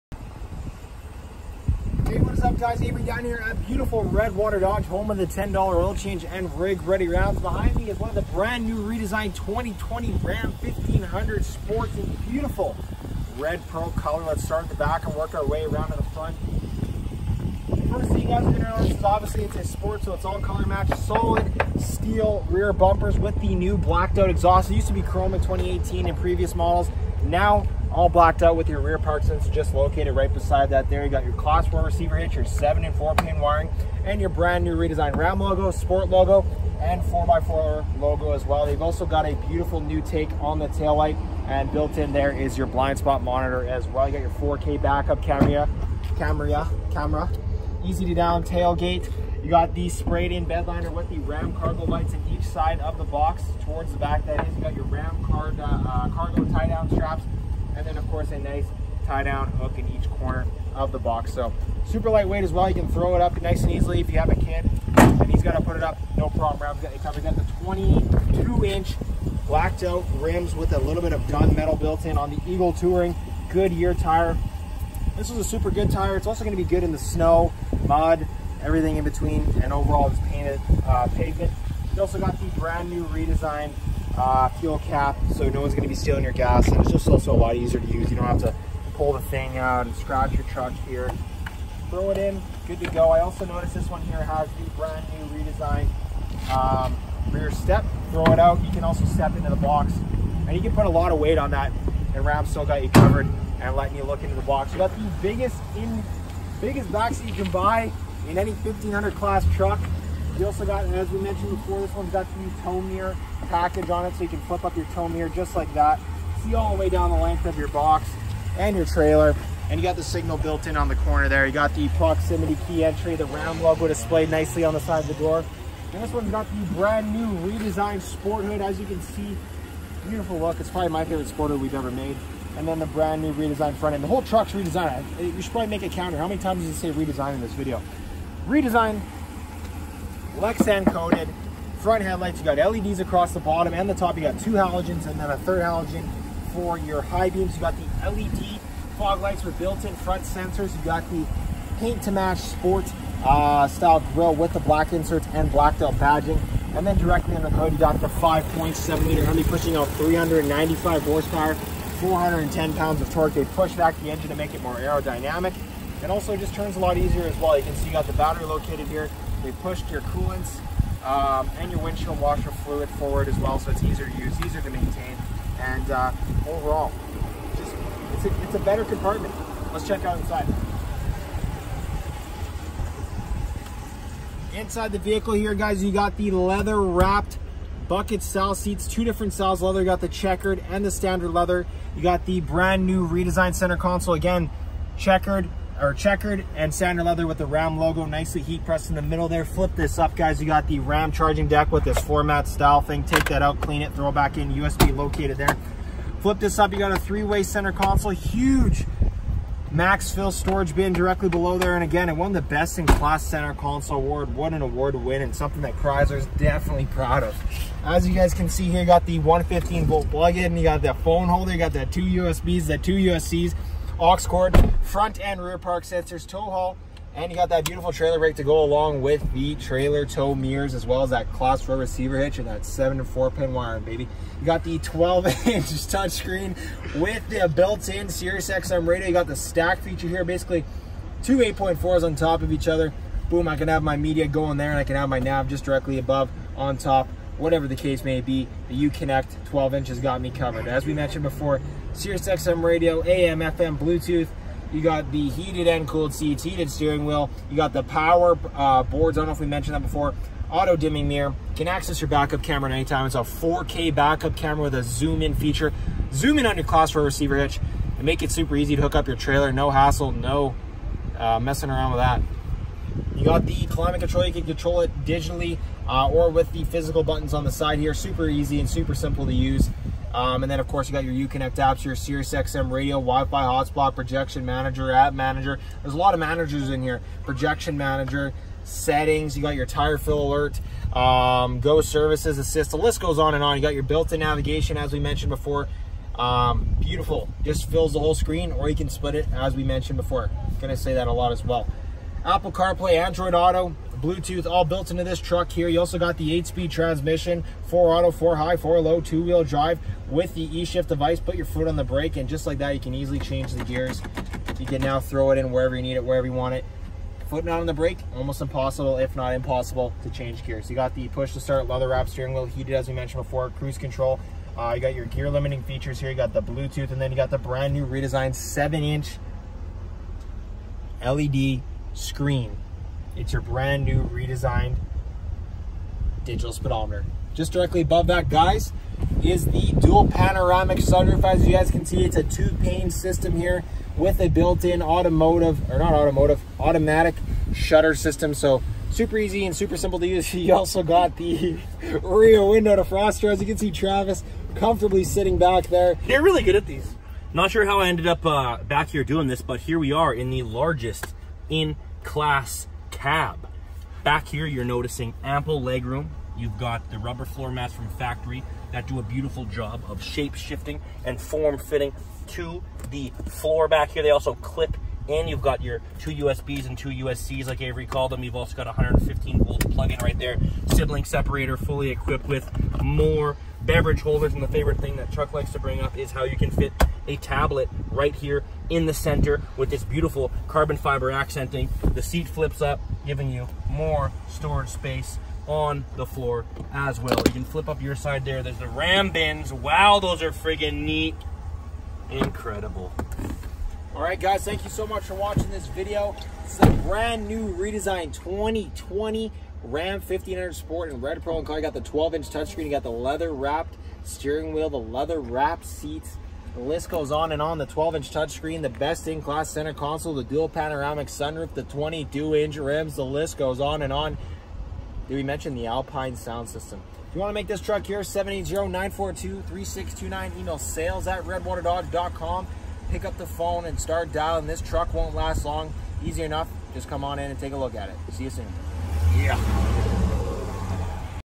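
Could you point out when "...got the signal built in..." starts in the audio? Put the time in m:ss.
1:59.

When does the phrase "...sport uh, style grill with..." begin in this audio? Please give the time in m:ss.
2:32.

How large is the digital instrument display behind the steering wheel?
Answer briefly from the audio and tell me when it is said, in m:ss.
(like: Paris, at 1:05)
7-inch, at 5:28.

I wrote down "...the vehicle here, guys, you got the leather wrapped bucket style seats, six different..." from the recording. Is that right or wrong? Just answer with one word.
wrong.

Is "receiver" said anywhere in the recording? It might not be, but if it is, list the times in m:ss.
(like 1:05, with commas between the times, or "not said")
0:31, 3:51, 4:27.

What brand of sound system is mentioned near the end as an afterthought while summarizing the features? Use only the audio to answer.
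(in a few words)
Alpine.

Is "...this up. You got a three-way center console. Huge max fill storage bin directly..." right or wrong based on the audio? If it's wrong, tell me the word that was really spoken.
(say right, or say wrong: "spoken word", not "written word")
right.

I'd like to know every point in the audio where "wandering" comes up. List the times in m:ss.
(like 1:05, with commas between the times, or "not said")
not said.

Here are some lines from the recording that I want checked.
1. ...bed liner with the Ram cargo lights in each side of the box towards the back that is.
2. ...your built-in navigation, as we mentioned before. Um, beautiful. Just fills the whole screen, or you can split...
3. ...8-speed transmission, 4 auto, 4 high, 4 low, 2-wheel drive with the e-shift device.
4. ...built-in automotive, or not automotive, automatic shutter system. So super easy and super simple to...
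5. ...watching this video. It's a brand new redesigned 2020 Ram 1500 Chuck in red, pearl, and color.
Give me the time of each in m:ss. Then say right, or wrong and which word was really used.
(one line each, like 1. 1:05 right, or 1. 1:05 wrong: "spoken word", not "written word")
1. 0:50 right
2. 4:53 right
3. 5:06 right
4. 5:44 right
5. 6:45 wrong: "Sport", not "Chuck".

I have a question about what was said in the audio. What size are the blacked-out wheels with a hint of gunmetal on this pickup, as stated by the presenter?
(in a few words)
22 inch.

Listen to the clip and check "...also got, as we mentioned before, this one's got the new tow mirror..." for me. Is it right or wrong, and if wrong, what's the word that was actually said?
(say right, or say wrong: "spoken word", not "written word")
right.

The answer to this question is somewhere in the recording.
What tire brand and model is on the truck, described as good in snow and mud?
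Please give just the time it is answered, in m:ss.
1:12.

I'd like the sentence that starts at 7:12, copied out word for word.
Pick up the phone and start dialing.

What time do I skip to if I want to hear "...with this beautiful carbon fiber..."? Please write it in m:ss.
6:29.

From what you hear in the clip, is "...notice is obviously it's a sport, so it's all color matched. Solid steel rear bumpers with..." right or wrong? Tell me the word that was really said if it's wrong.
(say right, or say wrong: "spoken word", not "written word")
right.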